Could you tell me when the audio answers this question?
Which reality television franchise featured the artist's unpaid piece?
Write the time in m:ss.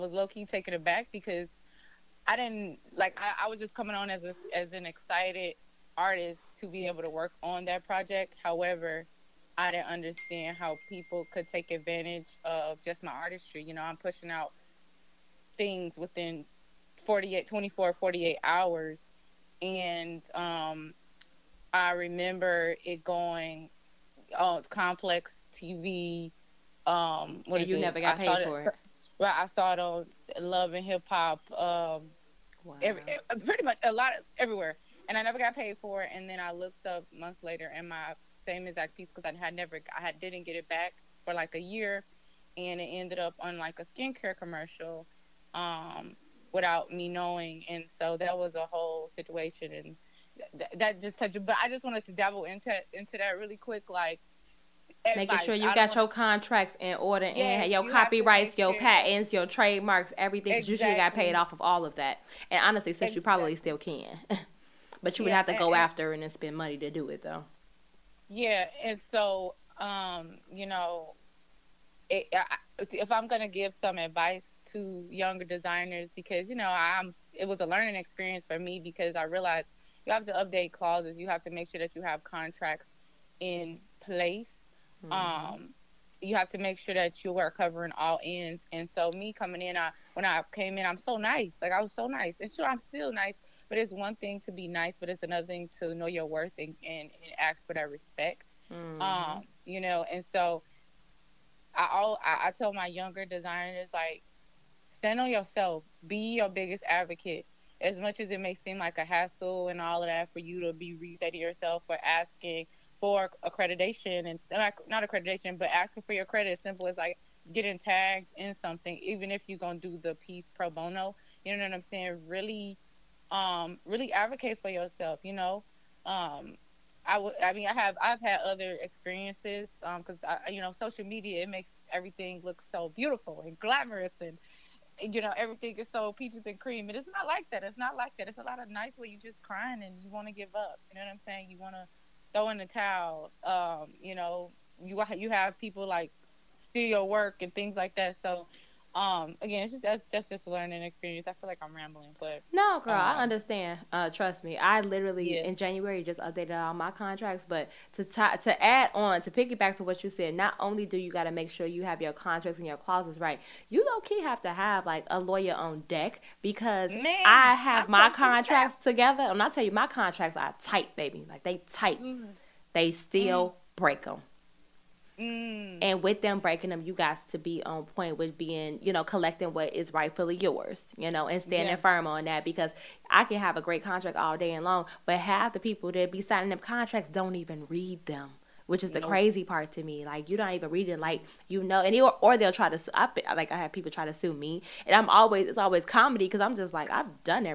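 0:30.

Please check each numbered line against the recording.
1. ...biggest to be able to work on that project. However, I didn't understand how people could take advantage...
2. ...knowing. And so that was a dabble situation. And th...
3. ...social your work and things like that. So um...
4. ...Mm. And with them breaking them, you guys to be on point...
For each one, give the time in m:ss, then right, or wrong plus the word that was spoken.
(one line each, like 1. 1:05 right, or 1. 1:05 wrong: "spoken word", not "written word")
1. 0:05 wrong: "artist", not "biggest"
2. 0:47 wrong: "whole", not "dabble"
3. 2:26 wrong: "steal", not "social"
4. 2:55 right.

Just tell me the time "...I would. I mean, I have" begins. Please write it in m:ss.
2:07.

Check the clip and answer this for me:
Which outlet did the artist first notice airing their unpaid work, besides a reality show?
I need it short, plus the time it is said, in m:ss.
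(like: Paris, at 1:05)
Complex TV, at 0:24.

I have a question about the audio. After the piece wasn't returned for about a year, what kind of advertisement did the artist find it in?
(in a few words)
skincare commercial.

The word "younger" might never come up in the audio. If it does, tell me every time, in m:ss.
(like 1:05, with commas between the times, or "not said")
1:15, 1:42.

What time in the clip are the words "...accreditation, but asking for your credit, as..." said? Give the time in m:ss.
1:55.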